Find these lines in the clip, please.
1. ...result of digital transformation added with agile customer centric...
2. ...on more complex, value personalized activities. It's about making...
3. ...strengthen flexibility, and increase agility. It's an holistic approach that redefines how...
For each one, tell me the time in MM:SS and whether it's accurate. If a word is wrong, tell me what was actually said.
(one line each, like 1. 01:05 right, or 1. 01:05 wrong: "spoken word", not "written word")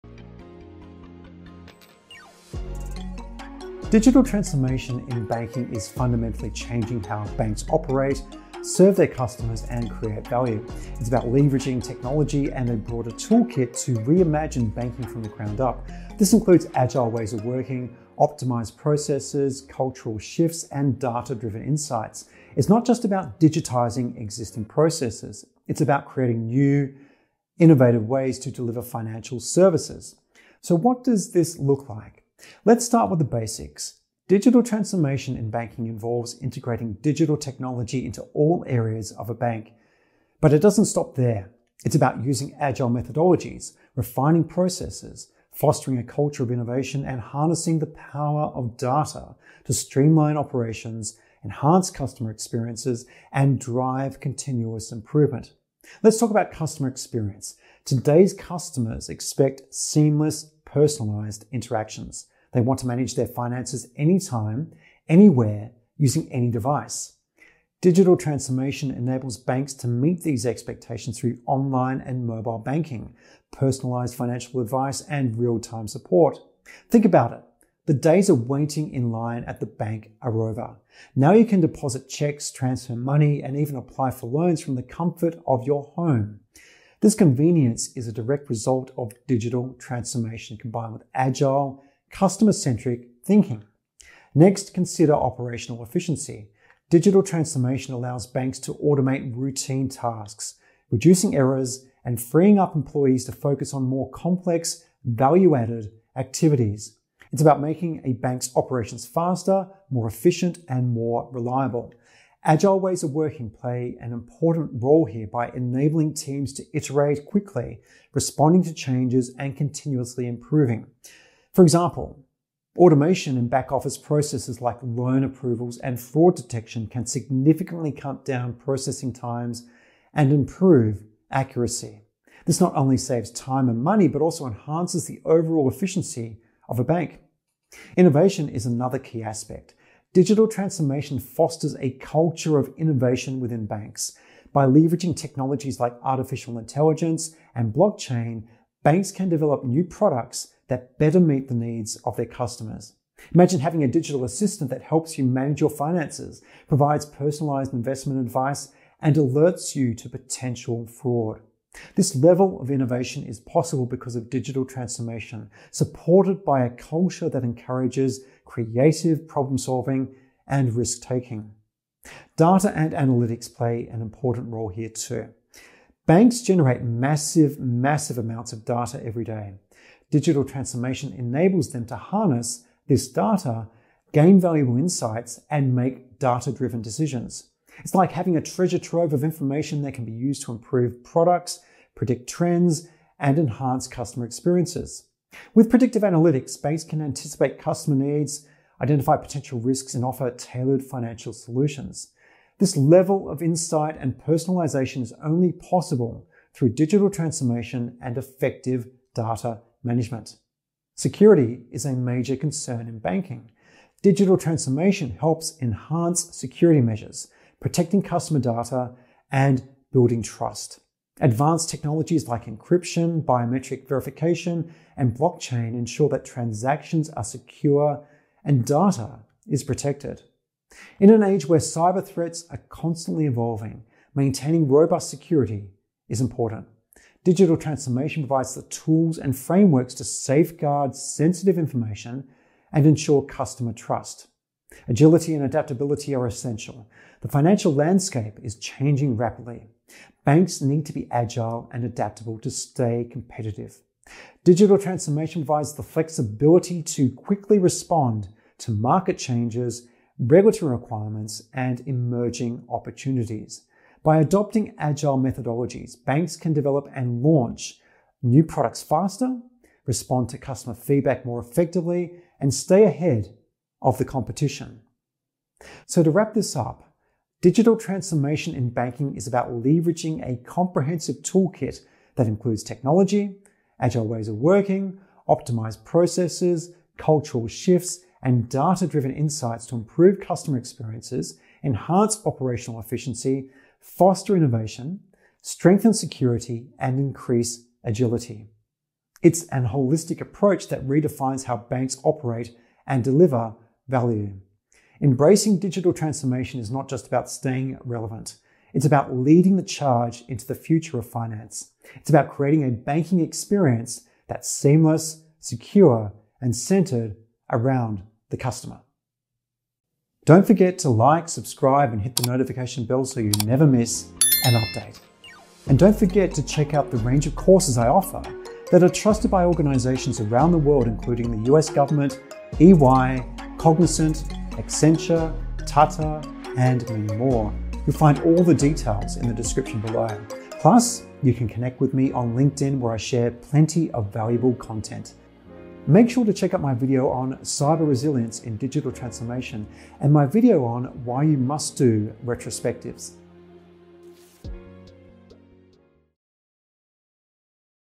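1. 01:28 wrong: "combined", not "added"
2. 01:43 wrong: "added", not "personalized"
3. 04:55 wrong: "security", not "flexibility".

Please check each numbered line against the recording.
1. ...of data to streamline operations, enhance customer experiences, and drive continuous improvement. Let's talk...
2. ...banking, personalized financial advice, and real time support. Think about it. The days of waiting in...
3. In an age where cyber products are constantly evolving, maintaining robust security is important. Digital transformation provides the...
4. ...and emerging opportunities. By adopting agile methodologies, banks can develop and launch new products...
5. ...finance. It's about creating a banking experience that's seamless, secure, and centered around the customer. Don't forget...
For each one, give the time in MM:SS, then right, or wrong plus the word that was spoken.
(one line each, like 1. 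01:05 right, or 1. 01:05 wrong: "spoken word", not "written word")
1. 00:48 right
2. 01:12 right
3. 03:50 wrong: "threats", not "products"
4. 04:21 right
5. 05:11 right.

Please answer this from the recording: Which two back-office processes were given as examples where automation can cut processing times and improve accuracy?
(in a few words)
Loan approvals and fraud detection.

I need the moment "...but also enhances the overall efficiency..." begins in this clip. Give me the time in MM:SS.
02:14.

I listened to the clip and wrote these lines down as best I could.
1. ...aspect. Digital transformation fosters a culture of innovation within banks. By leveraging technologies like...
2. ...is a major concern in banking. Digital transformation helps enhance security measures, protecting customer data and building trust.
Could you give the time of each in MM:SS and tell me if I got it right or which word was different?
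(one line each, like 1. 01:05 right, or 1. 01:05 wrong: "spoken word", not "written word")
1. 02:19 right
2. 03:31 right.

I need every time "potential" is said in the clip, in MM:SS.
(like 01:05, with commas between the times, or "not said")
02:40, 03:19.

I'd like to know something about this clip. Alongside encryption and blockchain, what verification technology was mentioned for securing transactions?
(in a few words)
Biometric verification.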